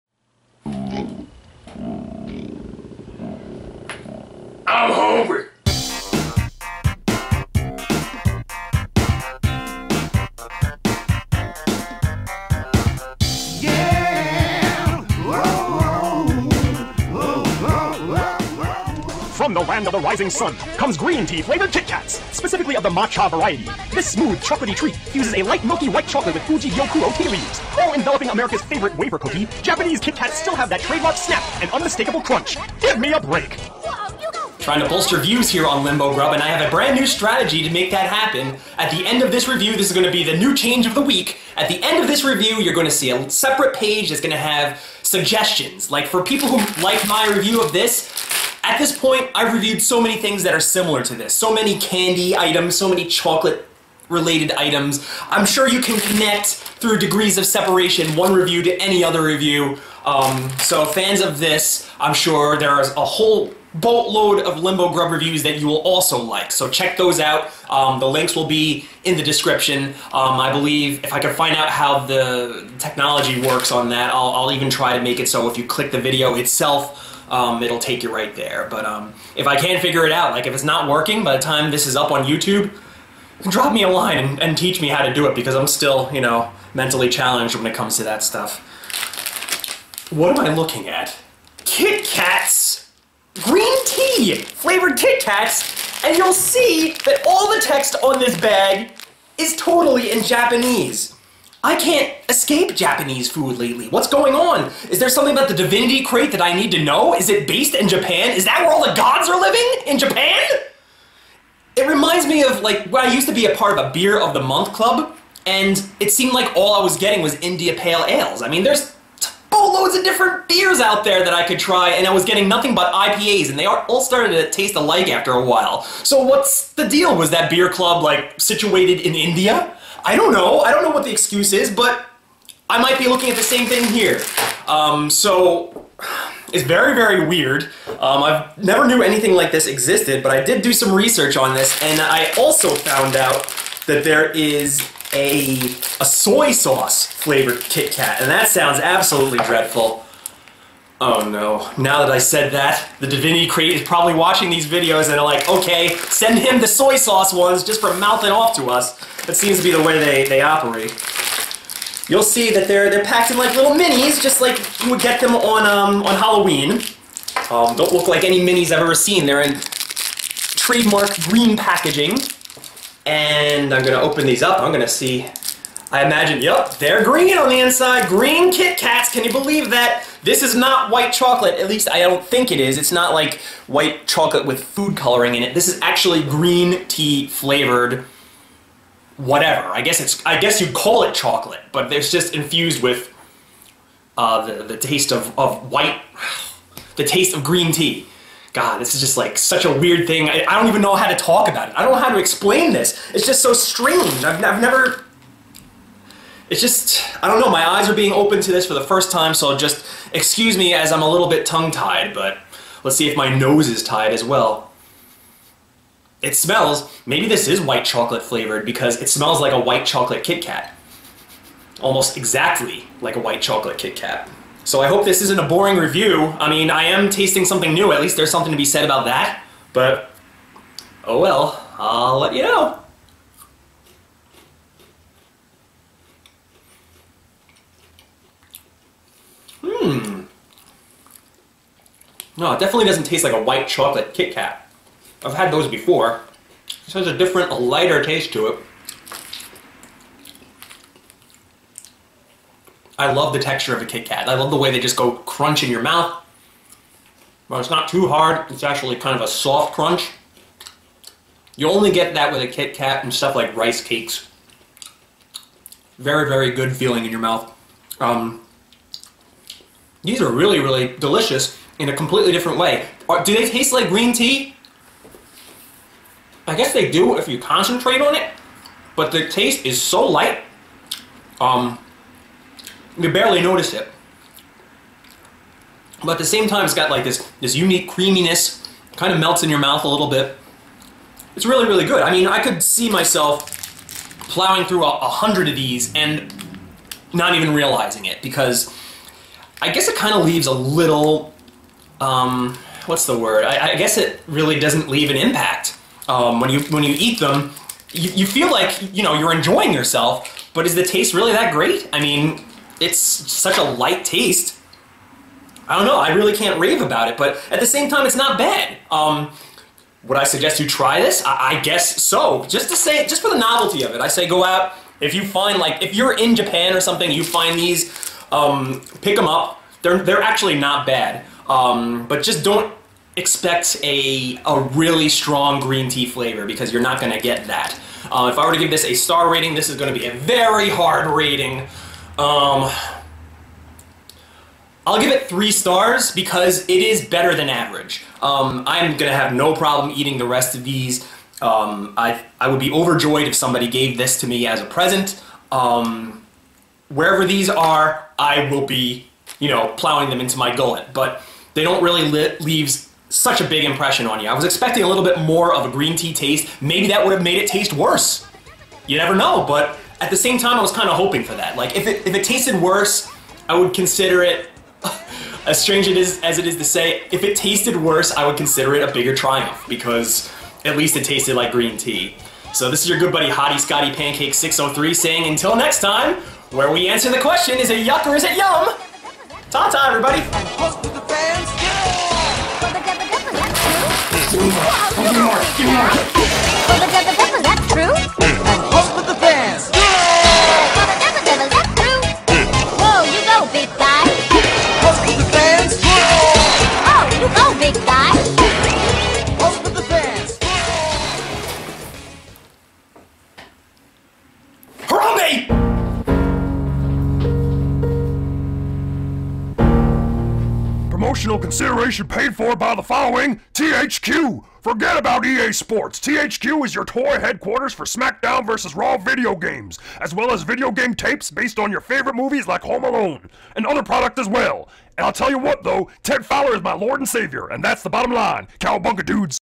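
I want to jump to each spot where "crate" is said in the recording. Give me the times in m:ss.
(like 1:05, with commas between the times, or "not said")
1:46, 2:33.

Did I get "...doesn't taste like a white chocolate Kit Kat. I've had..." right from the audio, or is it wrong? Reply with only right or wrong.
right.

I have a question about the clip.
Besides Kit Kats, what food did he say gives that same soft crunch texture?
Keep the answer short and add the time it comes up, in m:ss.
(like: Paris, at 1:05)
Rice cakes, at 4:23.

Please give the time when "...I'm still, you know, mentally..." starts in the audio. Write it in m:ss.
1:25.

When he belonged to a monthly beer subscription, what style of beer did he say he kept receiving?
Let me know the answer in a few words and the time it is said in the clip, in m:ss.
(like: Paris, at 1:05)
India Pale Ales, at 1:57.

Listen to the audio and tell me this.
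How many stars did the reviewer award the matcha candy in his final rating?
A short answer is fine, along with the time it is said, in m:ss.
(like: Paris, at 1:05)
3, at 5:45.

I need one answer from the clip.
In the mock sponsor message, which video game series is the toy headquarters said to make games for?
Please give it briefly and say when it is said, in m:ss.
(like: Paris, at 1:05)
SmackDown vs. Raw, at 7:07.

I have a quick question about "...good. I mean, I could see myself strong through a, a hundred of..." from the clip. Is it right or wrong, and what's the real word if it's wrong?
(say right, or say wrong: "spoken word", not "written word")
wrong: "plowing", not "strong".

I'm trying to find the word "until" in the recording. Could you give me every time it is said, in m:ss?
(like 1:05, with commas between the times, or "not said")
6:25.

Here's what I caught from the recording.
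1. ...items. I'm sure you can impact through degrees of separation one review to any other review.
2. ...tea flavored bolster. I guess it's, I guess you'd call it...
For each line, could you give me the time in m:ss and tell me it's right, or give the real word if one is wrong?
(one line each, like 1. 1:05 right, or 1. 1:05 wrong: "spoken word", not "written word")
1. 0:54 wrong: "connect", not "impact"
2. 3:06 wrong: "whatever", not "bolster".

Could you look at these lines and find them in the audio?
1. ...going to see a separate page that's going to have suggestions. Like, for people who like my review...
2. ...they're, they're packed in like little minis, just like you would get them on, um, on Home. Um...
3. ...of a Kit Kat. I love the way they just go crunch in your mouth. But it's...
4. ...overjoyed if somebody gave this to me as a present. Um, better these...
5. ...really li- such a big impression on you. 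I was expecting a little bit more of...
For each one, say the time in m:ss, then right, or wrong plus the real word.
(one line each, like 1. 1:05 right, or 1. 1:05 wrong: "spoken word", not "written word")
1. 0:42 right
2. 2:42 wrong: "Halloween", not "Home"
3. 4:13 right
4. 5:52 wrong: "wherever", not "better"
5. 6:01 right.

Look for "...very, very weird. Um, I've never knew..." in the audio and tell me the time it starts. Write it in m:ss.
2:16.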